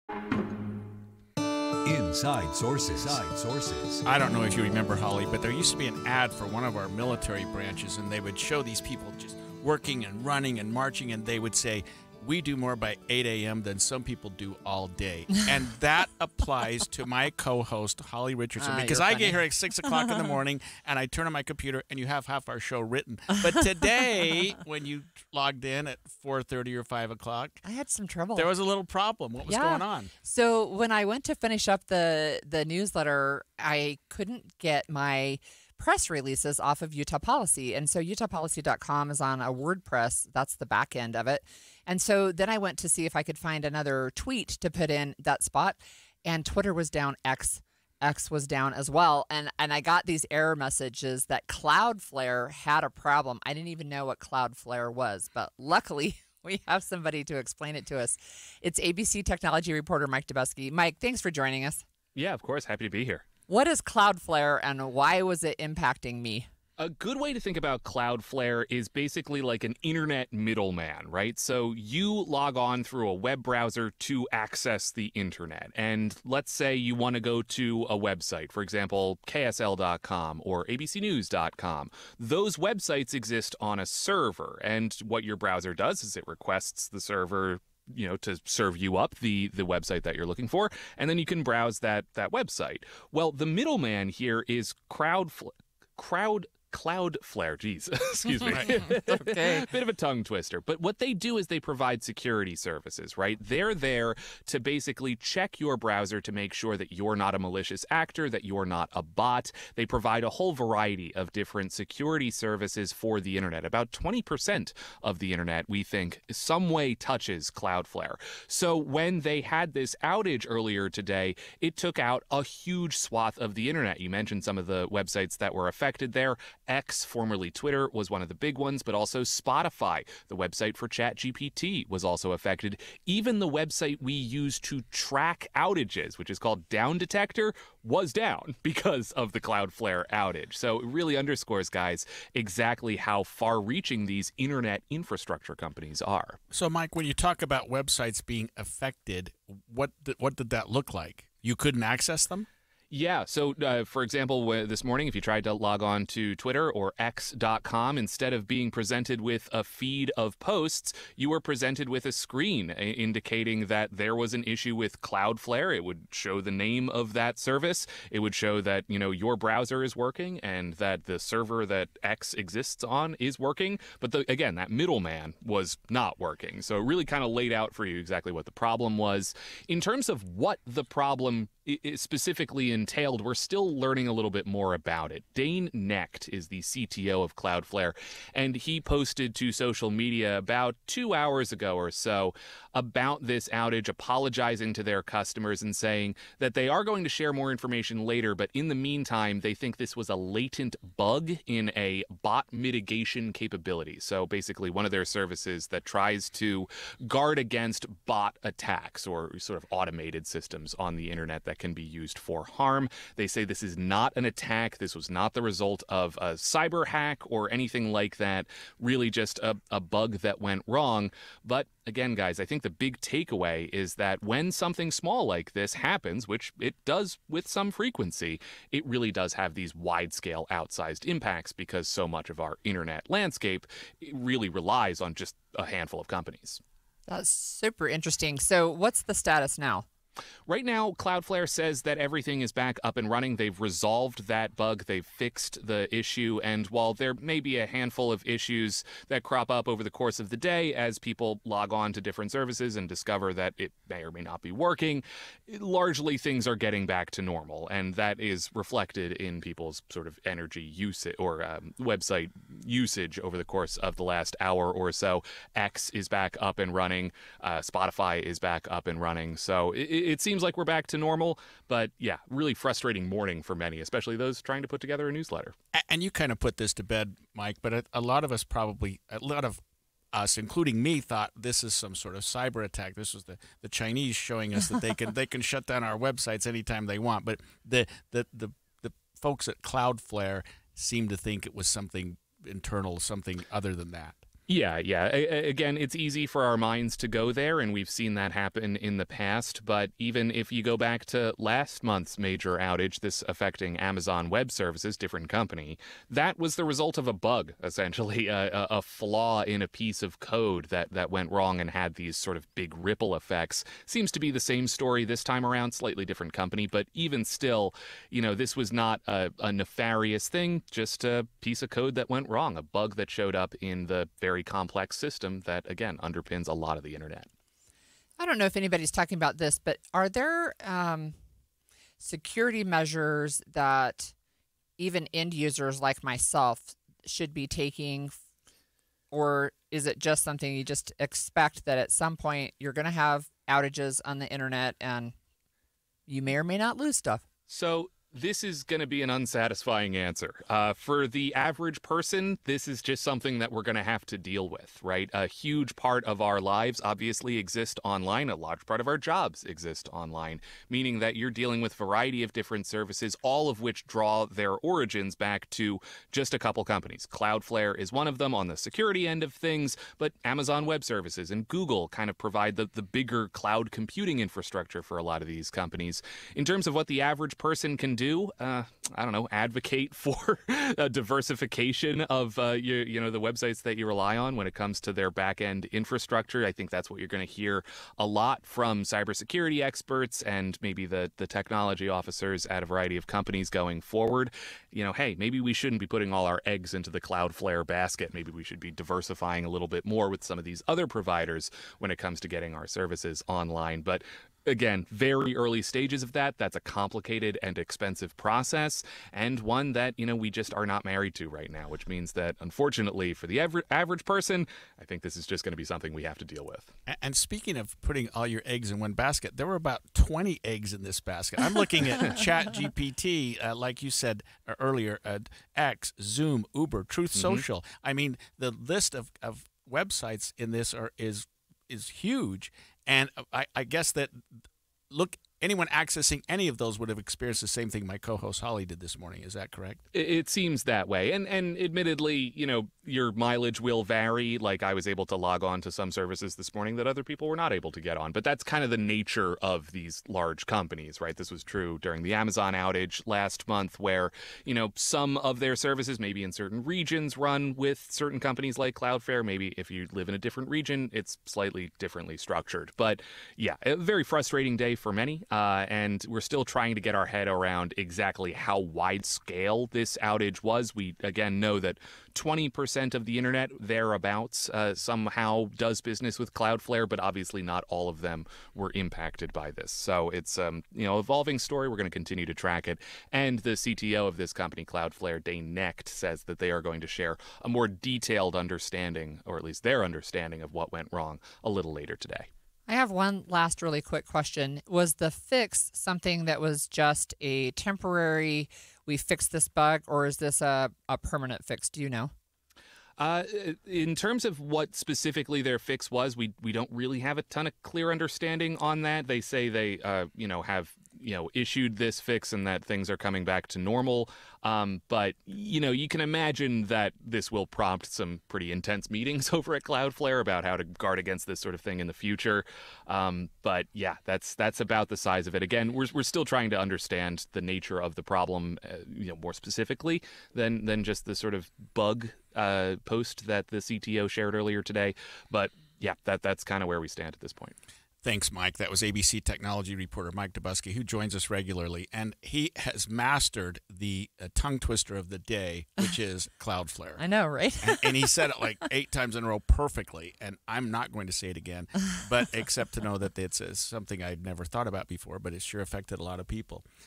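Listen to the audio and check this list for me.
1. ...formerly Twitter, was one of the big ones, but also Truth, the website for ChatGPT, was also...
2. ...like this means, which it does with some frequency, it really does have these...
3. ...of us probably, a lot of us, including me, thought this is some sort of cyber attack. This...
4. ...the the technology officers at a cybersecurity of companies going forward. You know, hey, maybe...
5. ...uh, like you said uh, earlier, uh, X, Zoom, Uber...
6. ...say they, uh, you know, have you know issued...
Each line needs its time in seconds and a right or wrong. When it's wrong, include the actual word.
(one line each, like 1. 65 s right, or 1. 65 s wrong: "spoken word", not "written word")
1. 127 s wrong: "Spotify", not "Truth"
2. 225 s wrong: "happens", not "means"
3. 278 s right
4. 390 s wrong: "variety", not "cybersecurity"
5. 423 s right
6. 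509 s right.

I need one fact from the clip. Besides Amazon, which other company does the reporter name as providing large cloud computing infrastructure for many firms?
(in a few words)
Google.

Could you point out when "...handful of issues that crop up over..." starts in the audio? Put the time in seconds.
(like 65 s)
247 s.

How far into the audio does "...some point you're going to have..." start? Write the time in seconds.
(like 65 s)
341 s.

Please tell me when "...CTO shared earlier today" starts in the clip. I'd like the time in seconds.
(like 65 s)
533 s.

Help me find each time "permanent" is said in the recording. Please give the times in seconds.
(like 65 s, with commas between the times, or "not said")
500 s.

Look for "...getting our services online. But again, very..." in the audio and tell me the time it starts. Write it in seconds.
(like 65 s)
402 s.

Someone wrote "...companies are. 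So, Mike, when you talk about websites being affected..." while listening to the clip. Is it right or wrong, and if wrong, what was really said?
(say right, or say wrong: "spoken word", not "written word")
right.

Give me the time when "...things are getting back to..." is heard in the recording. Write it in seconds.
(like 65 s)
256 s.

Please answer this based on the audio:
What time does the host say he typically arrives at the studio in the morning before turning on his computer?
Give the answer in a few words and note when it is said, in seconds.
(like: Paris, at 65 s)
6 o'clock, at 19 s.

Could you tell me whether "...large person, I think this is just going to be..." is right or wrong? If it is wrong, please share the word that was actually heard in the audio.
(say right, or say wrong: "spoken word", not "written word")
wrong: "average", not "large".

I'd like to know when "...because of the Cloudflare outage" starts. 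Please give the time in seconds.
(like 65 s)
138 s.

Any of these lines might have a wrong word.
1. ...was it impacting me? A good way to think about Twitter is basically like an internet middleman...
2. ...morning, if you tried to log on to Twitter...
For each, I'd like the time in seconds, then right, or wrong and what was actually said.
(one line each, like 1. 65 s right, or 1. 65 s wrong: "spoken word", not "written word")
1. 65 s wrong: "Cloudflare", not "Twitter"
2. 154 s right.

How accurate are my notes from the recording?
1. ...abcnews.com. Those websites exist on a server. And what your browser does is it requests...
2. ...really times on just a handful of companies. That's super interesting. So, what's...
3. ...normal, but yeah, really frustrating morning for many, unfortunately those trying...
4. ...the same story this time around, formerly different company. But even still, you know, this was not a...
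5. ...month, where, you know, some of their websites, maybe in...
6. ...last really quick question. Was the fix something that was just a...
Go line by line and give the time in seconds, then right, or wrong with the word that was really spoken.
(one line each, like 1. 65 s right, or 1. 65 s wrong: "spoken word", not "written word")
1. 80 s right
2. 234 s wrong: "relies", not "times"
3. 270 s wrong: "especially", not "unfortunately"
4. 314 s wrong: "slightly", not "formerly"
5. 453 s wrong: "services", not "websites"
6. 493 s right.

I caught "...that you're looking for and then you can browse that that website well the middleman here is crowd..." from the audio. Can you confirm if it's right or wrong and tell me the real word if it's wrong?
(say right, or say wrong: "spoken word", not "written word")
right.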